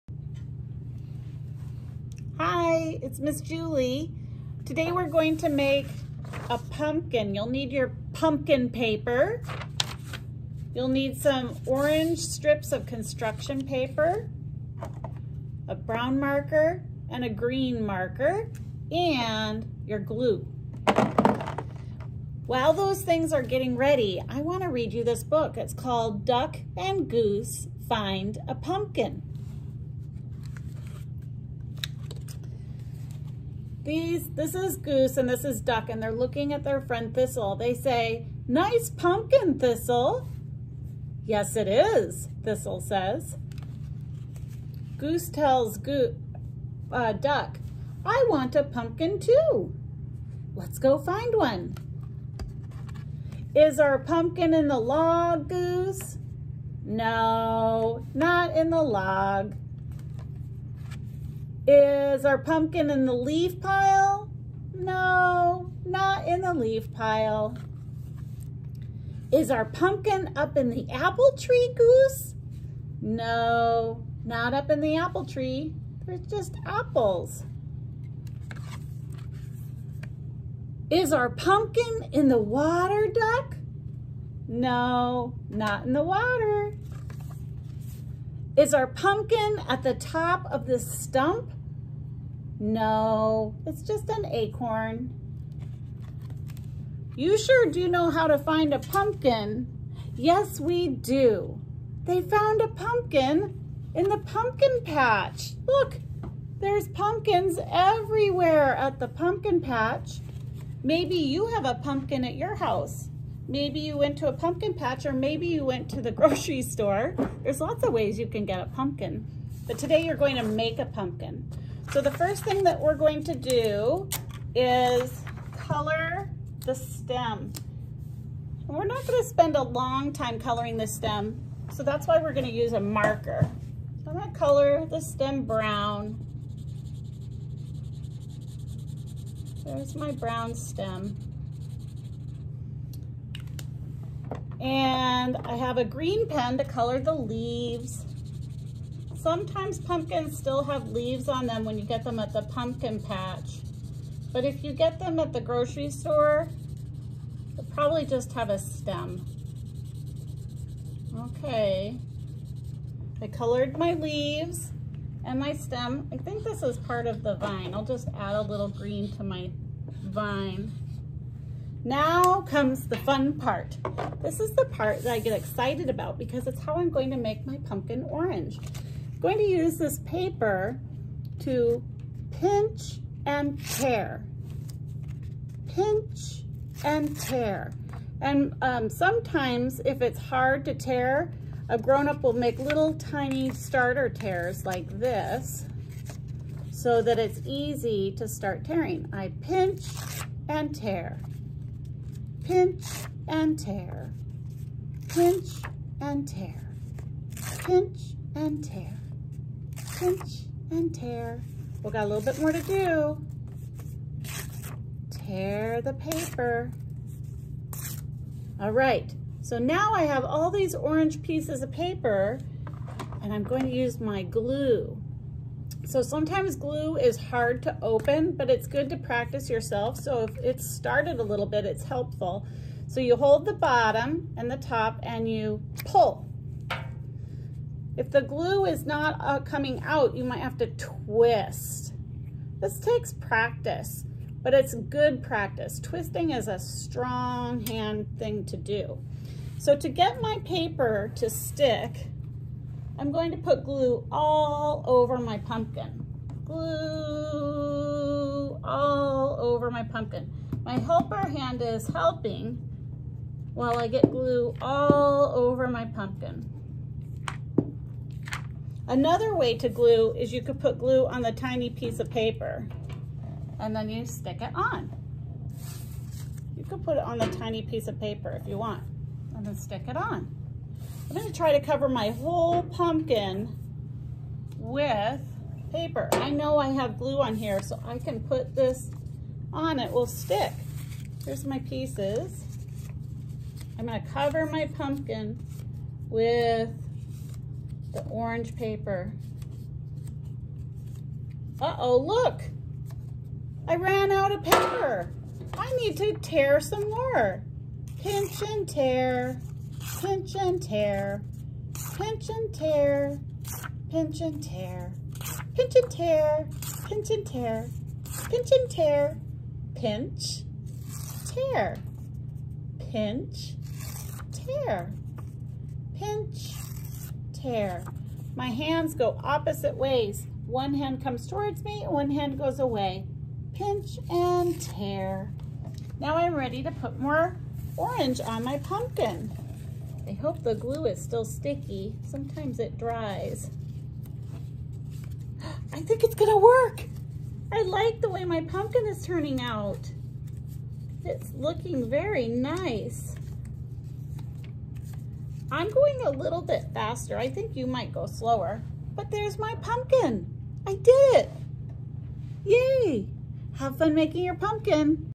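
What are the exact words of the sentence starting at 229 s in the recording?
So if it's started a little bit, it's helpful.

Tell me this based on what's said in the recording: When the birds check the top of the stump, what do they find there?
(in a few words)
An acorn.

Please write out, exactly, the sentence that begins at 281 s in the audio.
I'm gonna to try to cover my whole pumpkin with paper.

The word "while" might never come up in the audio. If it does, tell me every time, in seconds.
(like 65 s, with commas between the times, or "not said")
22 s, 263 s.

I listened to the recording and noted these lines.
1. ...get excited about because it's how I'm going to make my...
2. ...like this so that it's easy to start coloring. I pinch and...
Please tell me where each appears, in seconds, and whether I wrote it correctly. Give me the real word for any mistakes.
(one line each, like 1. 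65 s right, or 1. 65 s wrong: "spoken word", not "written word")
1. 175 s right
2. 194 s wrong: "tearing", not "coloring".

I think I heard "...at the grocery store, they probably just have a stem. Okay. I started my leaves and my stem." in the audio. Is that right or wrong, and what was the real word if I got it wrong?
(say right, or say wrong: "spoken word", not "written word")
wrong: "colored", not "started".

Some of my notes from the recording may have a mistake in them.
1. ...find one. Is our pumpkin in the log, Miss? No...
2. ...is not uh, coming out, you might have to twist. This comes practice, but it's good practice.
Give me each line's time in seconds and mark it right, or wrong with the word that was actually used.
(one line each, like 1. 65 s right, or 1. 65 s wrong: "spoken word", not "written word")
1. 50 s wrong: "Goose", not "Miss"
2. 238 s wrong: "takes", not "comes".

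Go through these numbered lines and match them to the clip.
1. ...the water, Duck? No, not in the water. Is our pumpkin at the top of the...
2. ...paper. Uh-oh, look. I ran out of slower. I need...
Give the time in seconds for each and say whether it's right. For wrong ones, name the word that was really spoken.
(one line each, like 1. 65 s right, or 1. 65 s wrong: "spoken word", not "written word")
1. 82 s right
2. 298 s wrong: "paper", not "slower".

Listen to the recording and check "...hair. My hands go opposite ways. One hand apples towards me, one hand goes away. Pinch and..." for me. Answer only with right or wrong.
wrong.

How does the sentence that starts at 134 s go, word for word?
So I'm gonna color the stem brown.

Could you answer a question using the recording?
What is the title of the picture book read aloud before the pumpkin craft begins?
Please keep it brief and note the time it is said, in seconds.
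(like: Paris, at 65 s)
Duck and Goose Find a Pumpkin, at 26 s.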